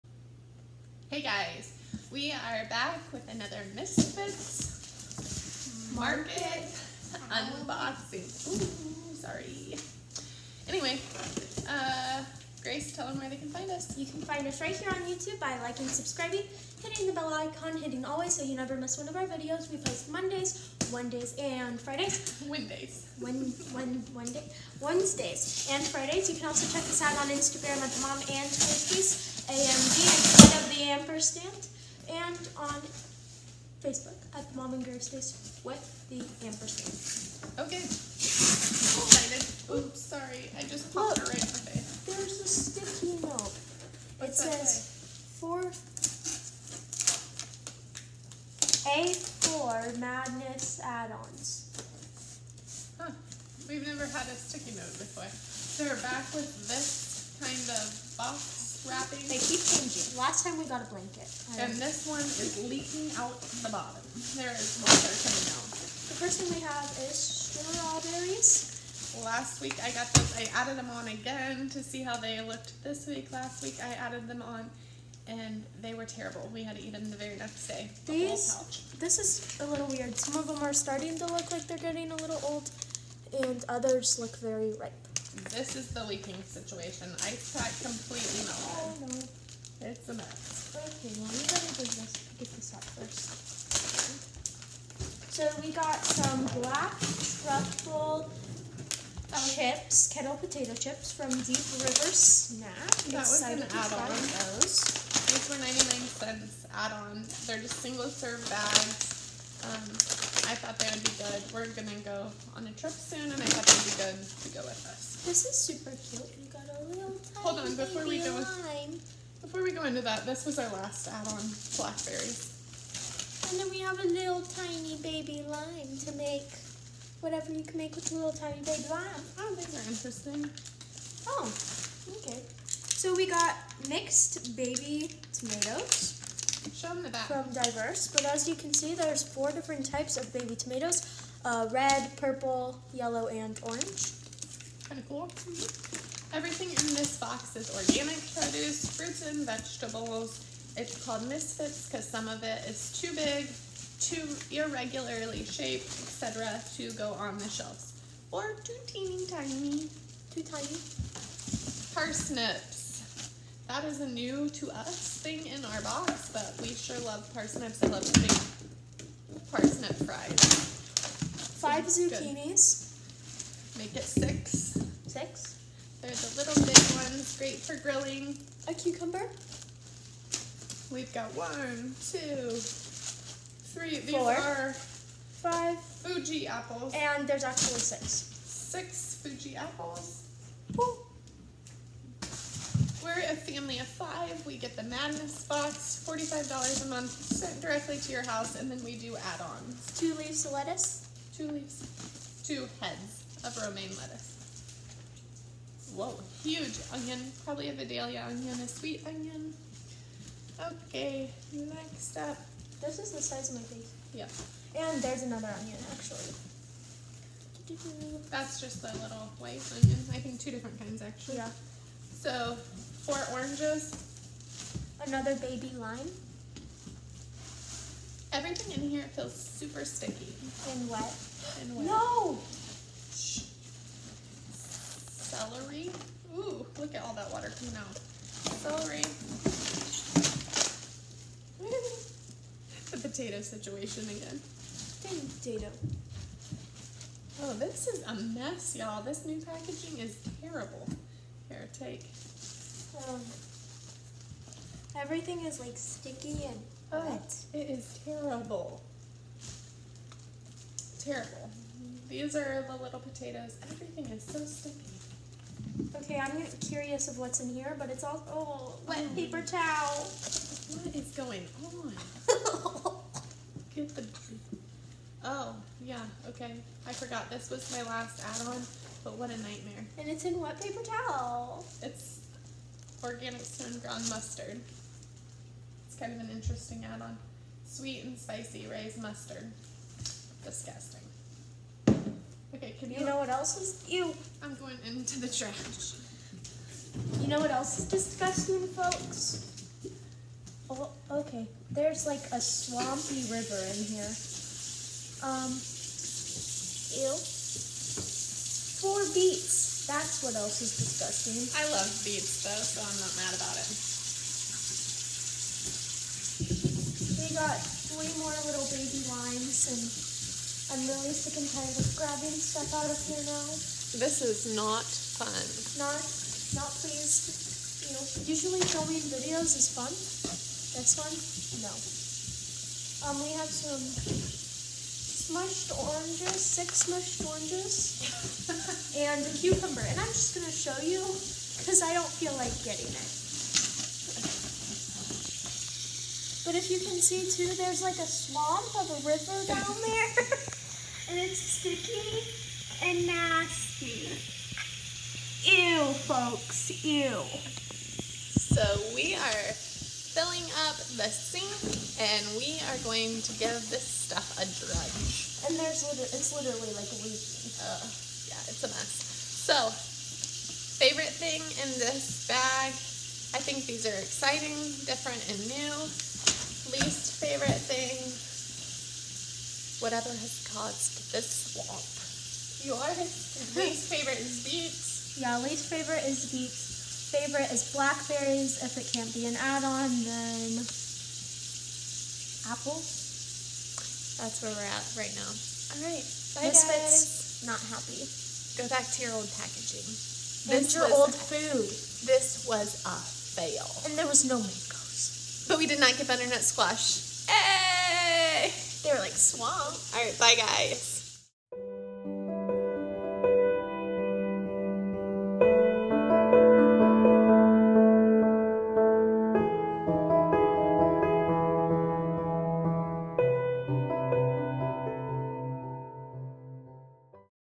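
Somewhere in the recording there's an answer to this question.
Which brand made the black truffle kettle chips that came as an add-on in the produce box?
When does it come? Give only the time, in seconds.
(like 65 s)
101 s.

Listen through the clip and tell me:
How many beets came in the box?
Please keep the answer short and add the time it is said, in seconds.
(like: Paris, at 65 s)
4, at 308 s.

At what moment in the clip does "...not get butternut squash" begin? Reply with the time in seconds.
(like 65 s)
405 s.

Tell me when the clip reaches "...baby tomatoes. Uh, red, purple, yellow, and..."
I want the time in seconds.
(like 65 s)
140 s.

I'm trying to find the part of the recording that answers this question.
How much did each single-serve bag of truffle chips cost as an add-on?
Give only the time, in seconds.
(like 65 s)
105 s.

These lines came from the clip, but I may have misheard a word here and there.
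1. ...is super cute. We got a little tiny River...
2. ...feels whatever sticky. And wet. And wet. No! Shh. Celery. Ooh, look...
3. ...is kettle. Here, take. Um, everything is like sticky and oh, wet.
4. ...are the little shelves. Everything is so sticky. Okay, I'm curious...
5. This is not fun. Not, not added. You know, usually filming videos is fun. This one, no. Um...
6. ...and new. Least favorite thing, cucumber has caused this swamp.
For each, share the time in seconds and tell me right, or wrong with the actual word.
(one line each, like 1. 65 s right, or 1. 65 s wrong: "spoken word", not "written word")
1. 115 s wrong: "Hold", not "River"
2. 229 s wrong: "super", not "whatever"
3. 249 s wrong: "terrible", not "kettle"
4. 262 s wrong: "potatoes", not "shelves"
5. 323 s wrong: "pleased", not "added"
6. 375 s wrong: "whatever", not "cucumber".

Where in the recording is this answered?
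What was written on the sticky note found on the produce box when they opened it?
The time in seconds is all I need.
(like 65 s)
45 s.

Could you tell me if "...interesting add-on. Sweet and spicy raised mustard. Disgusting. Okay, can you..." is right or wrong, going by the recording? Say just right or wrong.
right.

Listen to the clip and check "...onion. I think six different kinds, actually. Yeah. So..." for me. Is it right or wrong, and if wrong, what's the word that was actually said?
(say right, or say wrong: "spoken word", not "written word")
wrong: "two", not "six".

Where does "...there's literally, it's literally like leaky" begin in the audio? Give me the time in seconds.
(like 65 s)
365 s.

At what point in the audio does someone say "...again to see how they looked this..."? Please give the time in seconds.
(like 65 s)
71 s.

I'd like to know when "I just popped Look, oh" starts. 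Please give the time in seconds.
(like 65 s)
40 s.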